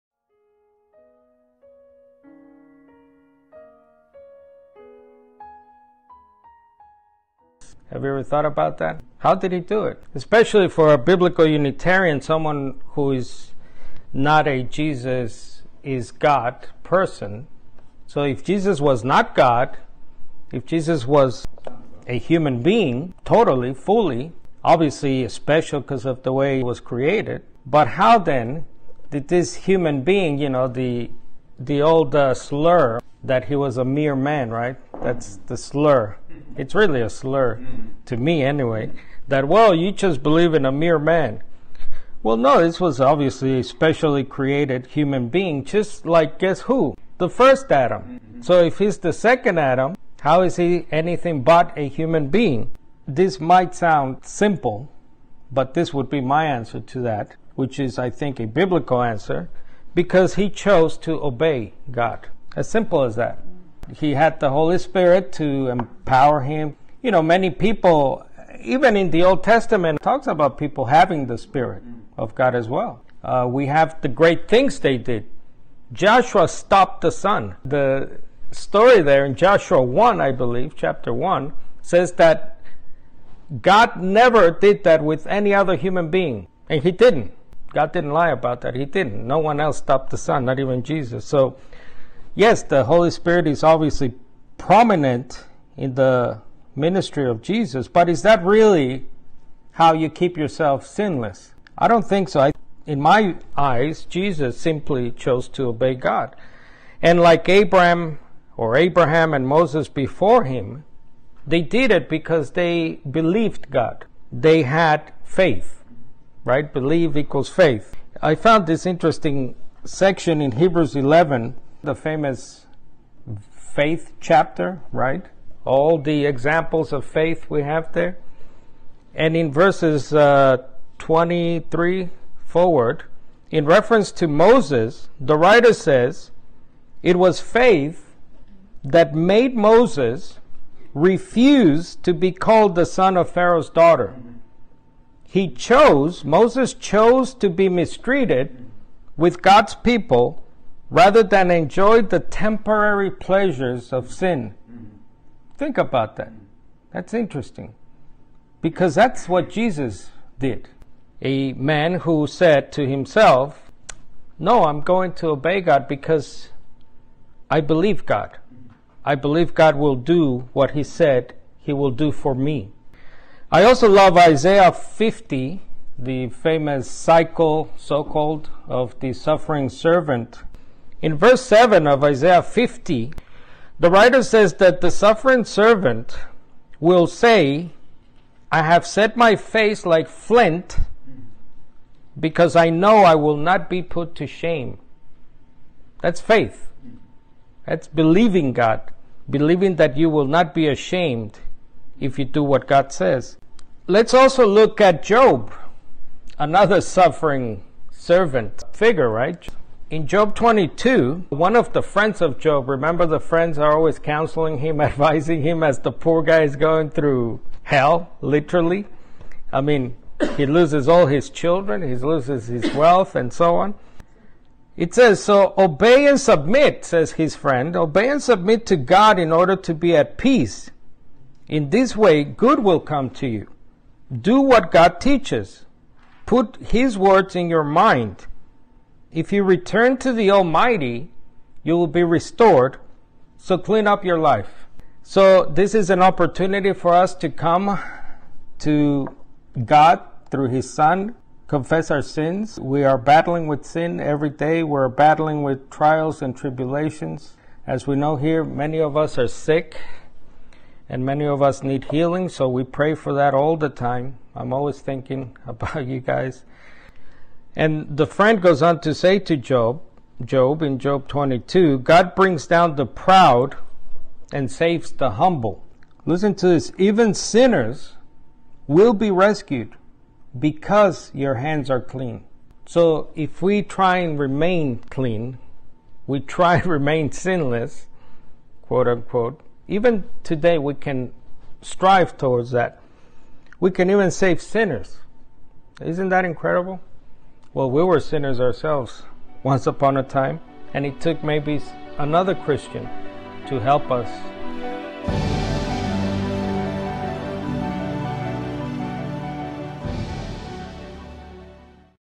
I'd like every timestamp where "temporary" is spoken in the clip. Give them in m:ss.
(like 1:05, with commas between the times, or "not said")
2:32.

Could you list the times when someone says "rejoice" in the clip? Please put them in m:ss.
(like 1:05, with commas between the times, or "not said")
not said.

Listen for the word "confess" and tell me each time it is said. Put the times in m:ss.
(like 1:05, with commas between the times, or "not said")
4:11.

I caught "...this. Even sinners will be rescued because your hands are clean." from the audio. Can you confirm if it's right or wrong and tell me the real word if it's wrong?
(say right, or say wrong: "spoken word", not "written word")
right.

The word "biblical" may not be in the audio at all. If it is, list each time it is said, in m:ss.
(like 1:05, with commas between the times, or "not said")
0:10, 0:58.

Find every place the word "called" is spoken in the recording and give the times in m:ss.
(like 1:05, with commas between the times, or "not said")
2:22, 2:58.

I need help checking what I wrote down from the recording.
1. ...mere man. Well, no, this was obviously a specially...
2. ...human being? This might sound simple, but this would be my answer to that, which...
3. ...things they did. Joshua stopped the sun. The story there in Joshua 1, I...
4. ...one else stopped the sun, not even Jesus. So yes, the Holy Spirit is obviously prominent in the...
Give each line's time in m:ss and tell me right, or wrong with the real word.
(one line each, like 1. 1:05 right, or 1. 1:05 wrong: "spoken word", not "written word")
1. 0:40 right
2. 0:51 right
3. 1:14 right
4. 1:29 right.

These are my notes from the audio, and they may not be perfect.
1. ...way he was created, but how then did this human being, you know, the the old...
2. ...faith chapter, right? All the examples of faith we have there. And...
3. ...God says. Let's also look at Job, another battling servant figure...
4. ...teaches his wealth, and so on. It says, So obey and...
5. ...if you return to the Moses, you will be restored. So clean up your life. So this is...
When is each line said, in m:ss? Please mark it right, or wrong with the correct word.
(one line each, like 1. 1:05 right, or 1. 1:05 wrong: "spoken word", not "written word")
1. 0:26 right
2. 2:03 right
3. 3:22 wrong: "suffering", not "battling"
4. 3:41 wrong: "loses", not "teaches"
5. 3:59 wrong: "Almighty", not "Moses".